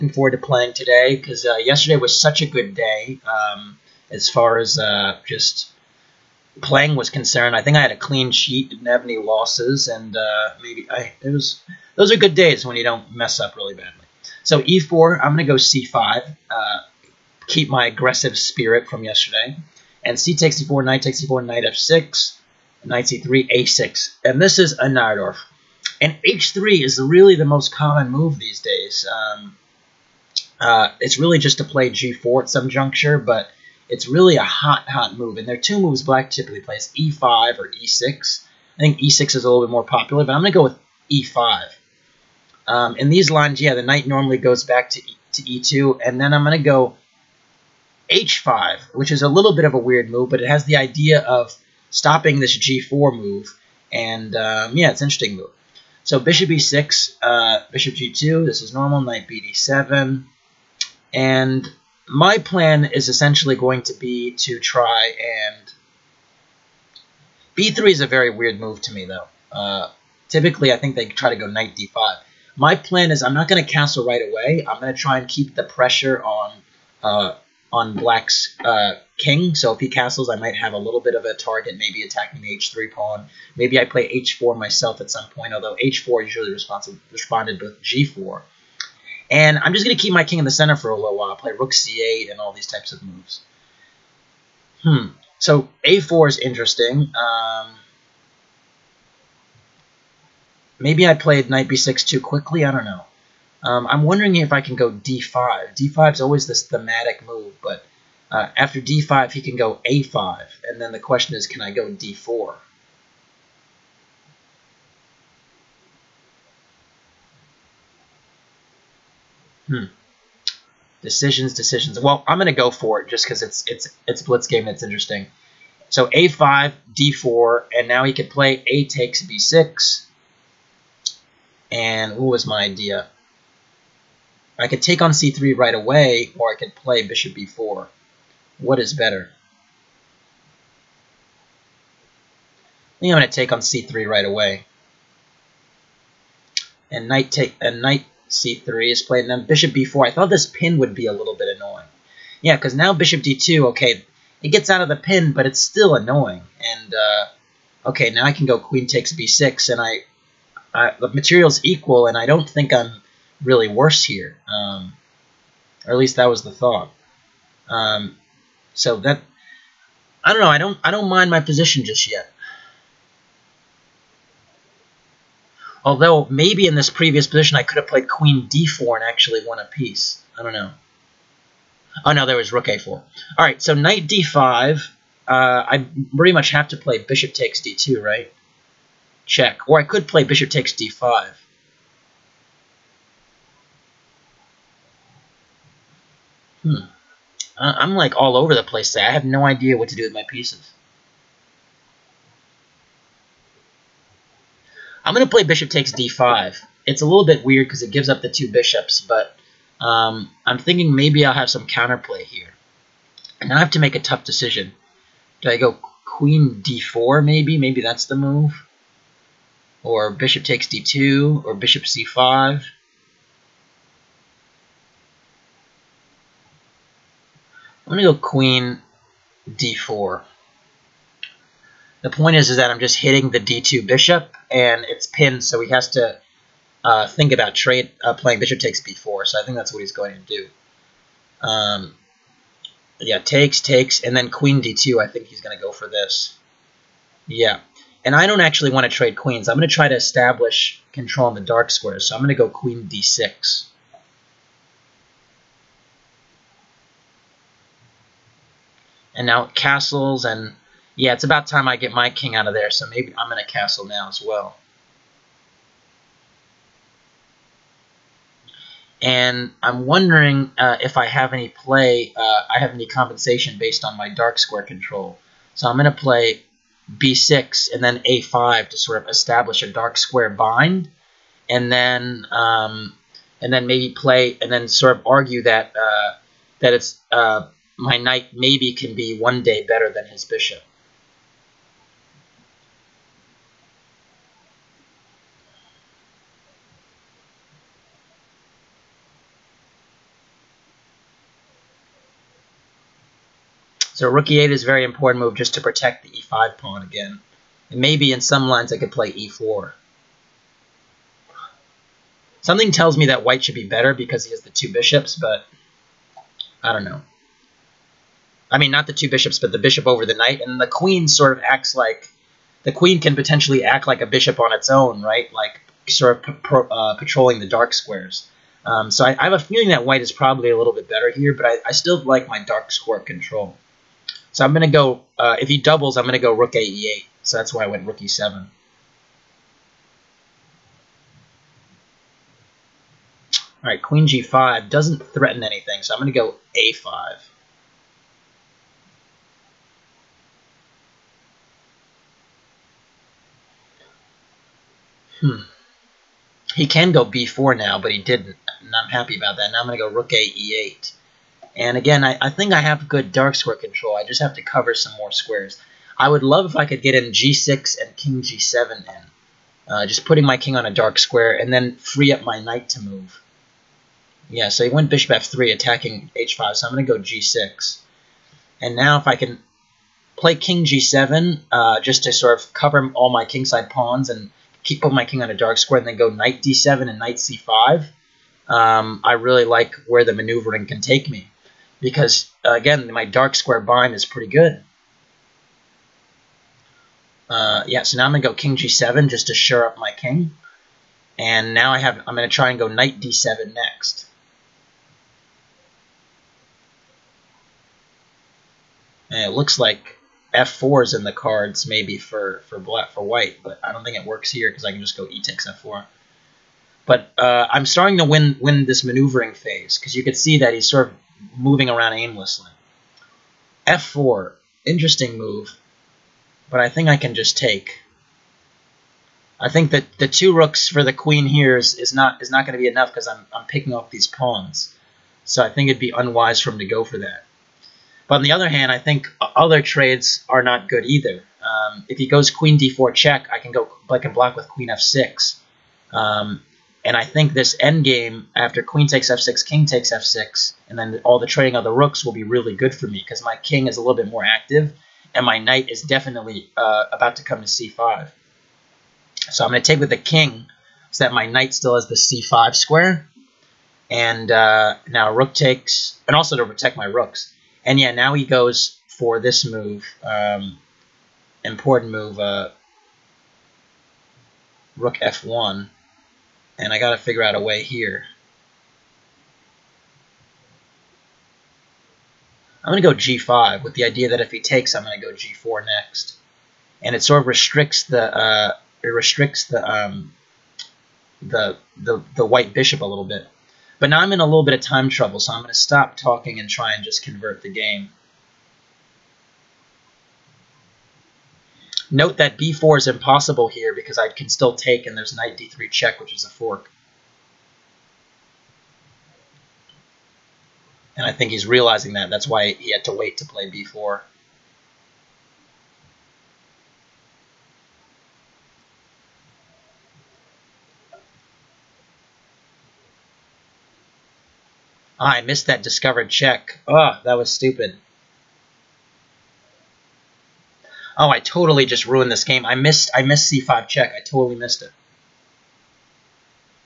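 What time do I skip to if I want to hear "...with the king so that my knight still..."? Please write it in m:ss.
7:39.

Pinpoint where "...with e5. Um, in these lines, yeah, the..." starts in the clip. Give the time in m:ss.
0:40.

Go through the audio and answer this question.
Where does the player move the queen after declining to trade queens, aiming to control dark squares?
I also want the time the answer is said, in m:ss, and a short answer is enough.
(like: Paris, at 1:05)
d6, at 4:12.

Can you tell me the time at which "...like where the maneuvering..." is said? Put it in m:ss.
6:29.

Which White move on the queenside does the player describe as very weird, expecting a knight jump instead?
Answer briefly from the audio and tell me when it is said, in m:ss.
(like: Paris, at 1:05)
b3, at 1:07.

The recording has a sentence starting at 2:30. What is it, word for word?
I thought this pin would be a little bit annoying.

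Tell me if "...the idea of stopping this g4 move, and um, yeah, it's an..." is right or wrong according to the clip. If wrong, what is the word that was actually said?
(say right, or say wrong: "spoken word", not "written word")
right.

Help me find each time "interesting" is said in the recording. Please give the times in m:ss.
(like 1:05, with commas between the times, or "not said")
0:55, 1:36, 2:04, 7:04.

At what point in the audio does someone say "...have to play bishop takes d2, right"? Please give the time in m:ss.
3:06.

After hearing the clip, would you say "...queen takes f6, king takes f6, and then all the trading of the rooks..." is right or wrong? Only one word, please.
right.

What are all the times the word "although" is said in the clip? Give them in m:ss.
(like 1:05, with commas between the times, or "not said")
1:25, 2:55.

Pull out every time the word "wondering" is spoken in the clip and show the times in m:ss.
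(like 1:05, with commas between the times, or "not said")
1:44, 4:29.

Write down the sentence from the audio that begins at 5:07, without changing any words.
And maybe in some lines I could play e4.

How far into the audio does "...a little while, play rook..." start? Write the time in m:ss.
1:30.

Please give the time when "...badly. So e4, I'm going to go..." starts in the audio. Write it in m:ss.
0:13.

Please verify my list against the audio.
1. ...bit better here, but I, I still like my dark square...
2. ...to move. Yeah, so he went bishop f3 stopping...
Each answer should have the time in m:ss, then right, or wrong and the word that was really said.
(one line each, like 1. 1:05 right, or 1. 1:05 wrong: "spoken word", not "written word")
1. 5:30 right
2. 6:12 wrong: "attacking", not "stopping".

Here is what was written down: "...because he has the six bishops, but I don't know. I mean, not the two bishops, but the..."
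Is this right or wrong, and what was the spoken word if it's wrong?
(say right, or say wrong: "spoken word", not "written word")
wrong: "two", not "six".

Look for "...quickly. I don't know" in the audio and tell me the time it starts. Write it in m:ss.
1:42.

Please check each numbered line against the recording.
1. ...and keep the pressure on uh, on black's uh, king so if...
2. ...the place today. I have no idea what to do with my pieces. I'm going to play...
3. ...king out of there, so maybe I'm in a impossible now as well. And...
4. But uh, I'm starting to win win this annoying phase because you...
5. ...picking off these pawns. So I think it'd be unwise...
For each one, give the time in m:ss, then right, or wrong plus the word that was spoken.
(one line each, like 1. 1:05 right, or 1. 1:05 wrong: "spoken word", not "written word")
1. 1:15 right
2. 3:18 right
3. 4:22 wrong: "castle", not "impossible"
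4. 6:56 wrong: "maneuvering", not "annoying"
5. 7:13 right.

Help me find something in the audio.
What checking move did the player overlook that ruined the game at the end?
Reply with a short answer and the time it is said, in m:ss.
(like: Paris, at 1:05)
c5 check, at 8:53.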